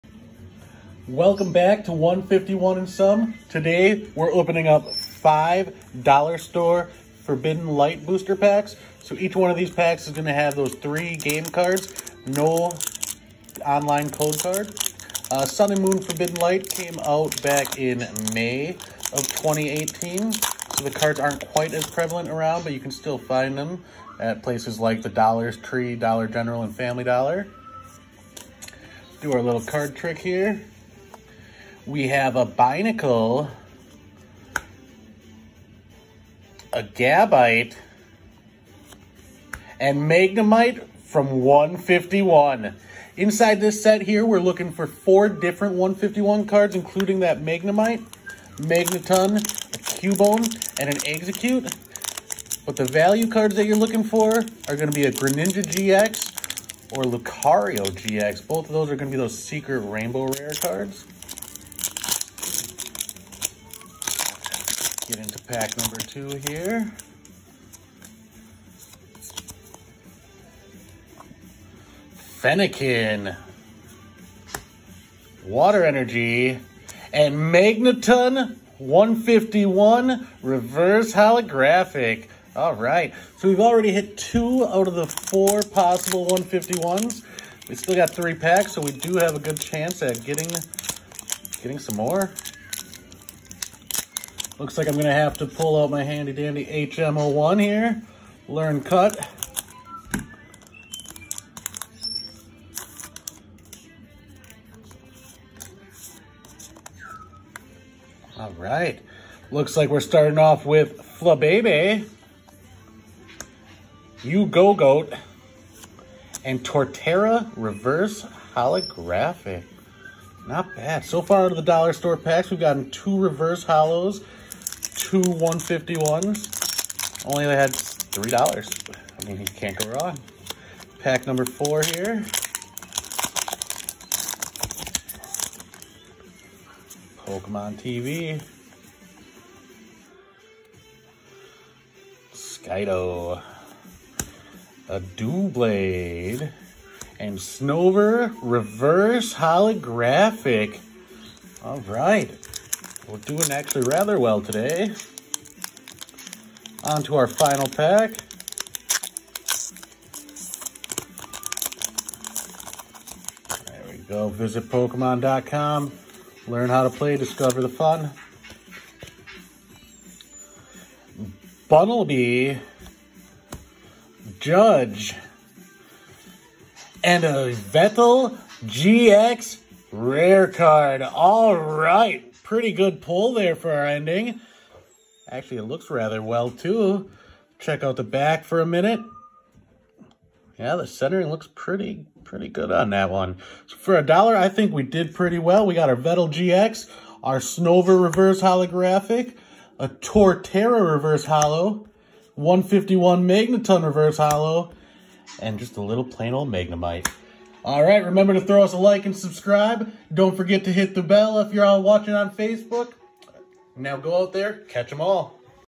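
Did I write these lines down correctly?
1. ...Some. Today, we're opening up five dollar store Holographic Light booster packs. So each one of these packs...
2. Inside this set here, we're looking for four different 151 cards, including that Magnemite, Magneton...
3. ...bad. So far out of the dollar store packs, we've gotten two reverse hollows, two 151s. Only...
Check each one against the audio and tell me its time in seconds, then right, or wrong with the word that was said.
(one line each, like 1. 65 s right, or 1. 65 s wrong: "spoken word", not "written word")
1. 2 s wrong: "Forbidden", not "Holographic"
2. 43 s right
3. 120 s right.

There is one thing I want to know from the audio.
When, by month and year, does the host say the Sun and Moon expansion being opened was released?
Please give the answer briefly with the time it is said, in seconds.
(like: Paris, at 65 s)
May 2018, at 18 s.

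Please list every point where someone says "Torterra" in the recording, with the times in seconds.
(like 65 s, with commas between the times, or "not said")
116 s, 199 s.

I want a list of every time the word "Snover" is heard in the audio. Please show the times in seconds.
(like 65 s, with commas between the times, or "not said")
147 s, 197 s.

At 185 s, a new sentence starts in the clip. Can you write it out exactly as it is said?
Actually, it looks rather well, too.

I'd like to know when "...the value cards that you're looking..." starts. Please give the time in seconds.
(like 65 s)
52 s.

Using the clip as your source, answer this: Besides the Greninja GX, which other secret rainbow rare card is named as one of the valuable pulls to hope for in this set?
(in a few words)
Lucario GX.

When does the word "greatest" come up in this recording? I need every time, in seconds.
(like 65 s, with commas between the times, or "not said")
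not said.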